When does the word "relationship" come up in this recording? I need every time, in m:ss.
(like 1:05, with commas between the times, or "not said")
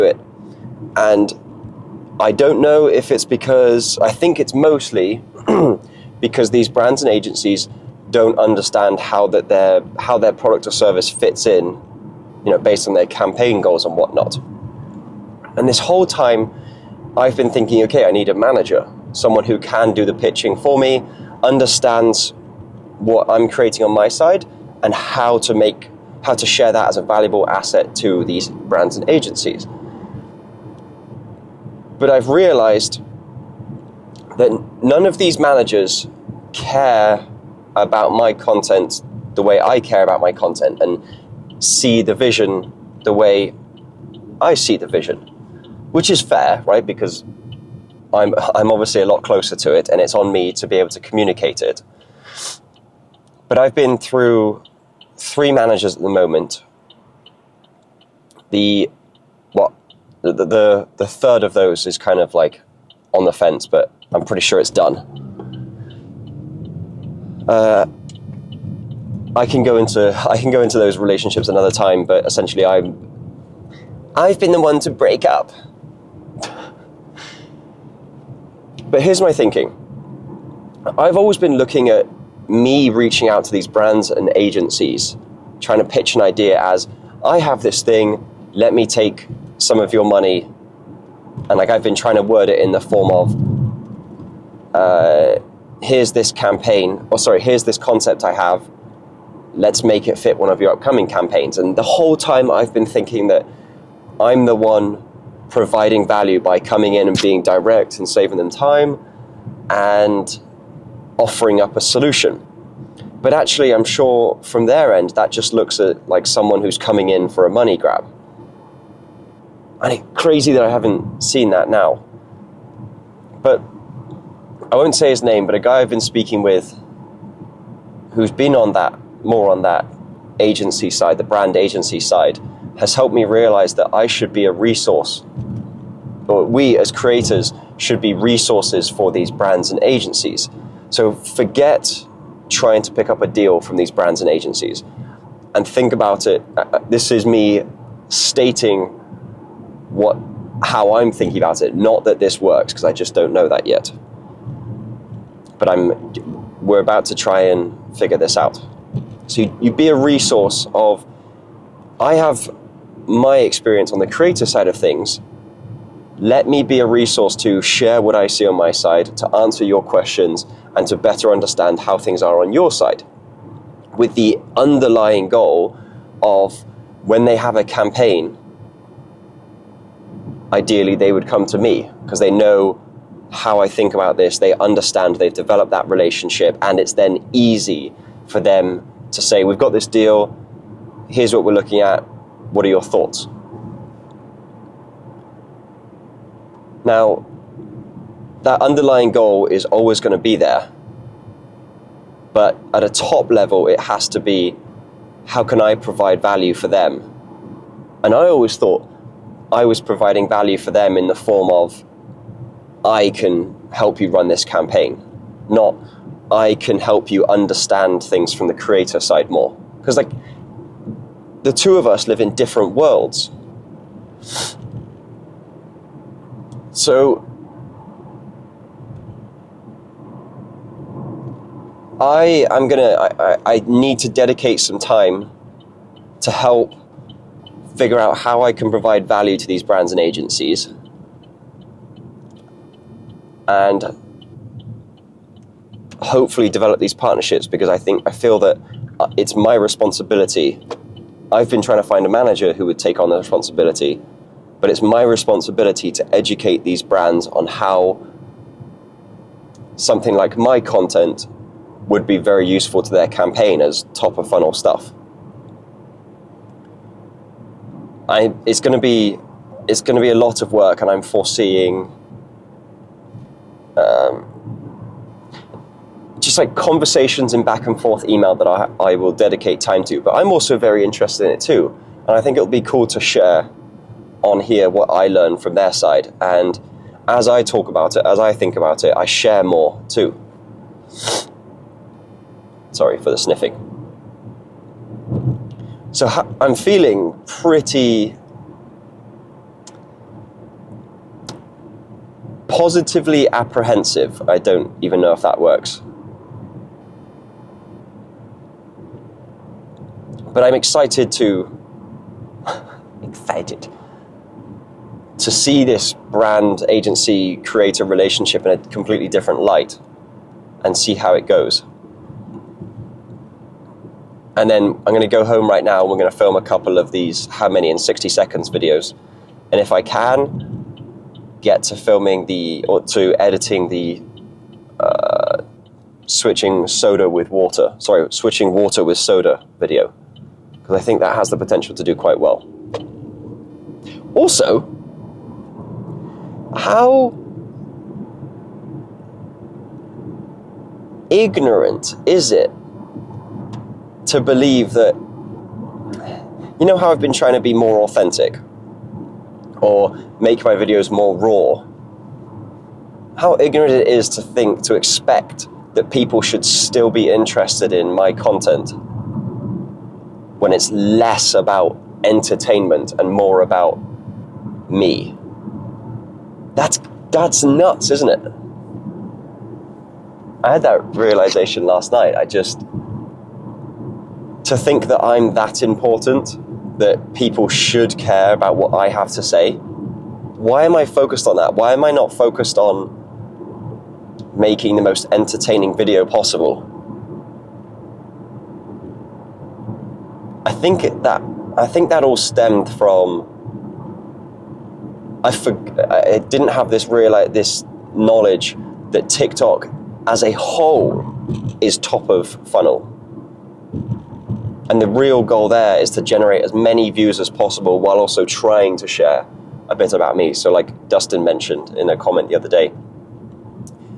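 1:10, 3:05, 5:17.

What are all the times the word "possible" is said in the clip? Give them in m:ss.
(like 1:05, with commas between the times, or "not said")
6:36, 6:57.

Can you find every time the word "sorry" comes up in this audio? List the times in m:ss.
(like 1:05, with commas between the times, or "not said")
1:37, 4:52, 5:37.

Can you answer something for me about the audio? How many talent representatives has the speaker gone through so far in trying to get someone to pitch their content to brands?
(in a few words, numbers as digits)
3.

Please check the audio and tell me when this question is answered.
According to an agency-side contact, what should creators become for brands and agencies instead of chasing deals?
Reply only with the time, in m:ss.
2:18.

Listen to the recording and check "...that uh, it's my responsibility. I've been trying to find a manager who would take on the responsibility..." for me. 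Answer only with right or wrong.
right.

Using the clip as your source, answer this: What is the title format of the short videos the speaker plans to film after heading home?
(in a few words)
How many in 60 seconds.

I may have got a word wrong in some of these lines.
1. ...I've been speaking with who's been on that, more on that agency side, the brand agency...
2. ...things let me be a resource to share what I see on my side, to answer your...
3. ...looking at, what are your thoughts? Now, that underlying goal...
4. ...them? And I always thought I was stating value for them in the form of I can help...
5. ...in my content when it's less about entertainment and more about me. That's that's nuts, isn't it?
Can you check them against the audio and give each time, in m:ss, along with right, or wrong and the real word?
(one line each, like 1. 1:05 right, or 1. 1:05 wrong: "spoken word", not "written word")
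1. 2:05 right
2. 2:44 right
3. 3:11 right
4. 3:26 wrong: "providing", not "stating"
5. 6:07 right.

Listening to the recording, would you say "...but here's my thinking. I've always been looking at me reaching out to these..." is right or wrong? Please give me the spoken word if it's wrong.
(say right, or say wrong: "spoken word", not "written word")
right.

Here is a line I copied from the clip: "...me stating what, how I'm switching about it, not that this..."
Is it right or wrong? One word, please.
wrong.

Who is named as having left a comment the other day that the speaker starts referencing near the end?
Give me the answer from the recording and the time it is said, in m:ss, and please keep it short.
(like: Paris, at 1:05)
Dustin, at 7:00.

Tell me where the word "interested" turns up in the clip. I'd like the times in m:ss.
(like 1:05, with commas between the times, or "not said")
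4:40, 6:07.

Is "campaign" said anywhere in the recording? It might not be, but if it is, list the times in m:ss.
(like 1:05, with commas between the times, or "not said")
0:13, 1:36, 1:41, 2:57, 3:34, 4:23.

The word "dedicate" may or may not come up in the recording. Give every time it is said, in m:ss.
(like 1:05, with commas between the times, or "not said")
3:54, 4:39.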